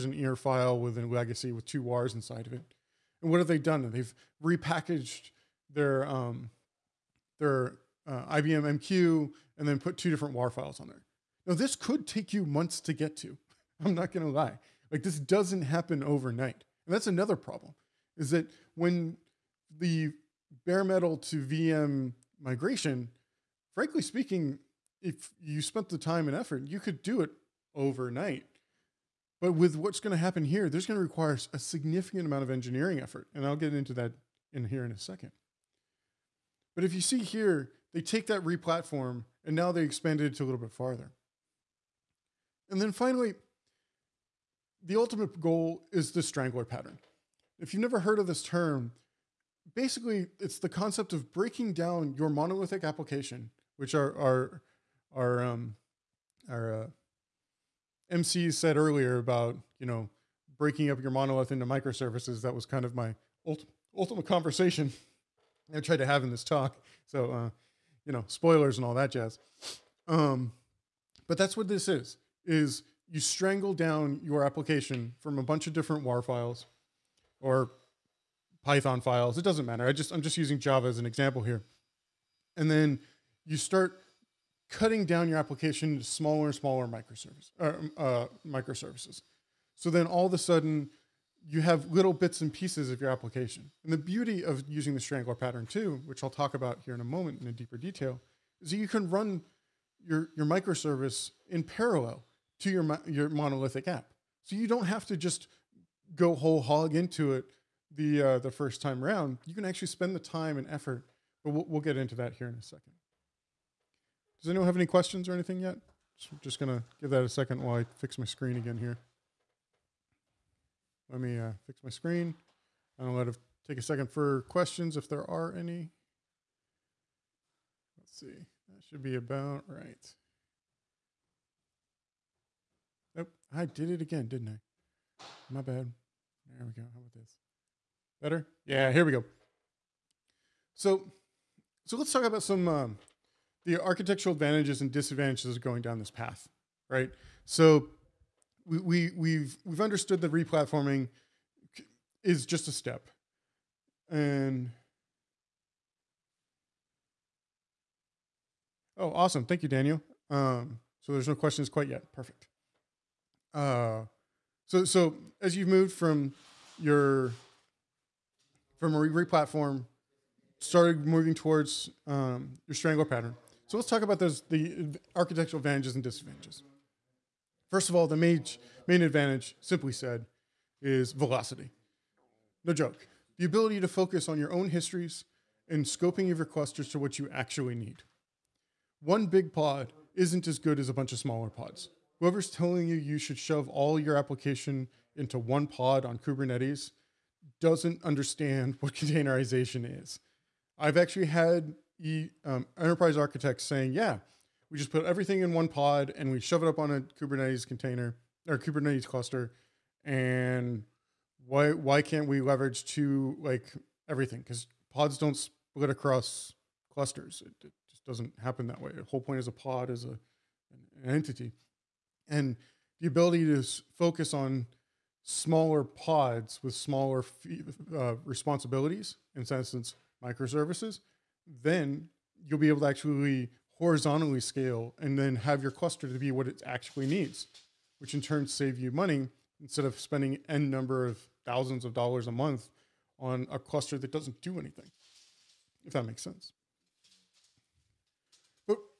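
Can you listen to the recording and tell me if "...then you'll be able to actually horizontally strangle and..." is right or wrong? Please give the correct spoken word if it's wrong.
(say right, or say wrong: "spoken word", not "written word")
wrong: "scale", not "strangle".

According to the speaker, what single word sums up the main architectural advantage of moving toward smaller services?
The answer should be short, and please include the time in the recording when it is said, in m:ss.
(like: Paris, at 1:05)
velocity, at 3:01.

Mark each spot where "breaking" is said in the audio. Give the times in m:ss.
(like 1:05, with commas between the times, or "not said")
0:51, 1:00.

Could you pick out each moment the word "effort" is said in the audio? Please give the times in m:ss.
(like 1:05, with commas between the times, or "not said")
0:26, 0:32, 1:50.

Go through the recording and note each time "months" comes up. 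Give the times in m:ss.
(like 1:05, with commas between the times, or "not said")
0:12, 4:02.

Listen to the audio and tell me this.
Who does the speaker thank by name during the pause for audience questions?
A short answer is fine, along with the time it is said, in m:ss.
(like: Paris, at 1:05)
Daniel, at 2:39.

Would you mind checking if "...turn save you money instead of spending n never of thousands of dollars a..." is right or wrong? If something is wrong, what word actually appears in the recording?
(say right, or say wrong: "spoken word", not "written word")
wrong: "number", not "never".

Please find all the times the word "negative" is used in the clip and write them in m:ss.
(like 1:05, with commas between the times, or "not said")
not said.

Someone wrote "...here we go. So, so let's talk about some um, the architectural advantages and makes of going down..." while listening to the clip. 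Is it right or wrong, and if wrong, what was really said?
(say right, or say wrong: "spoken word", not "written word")
wrong: "disadvantages", not "makes".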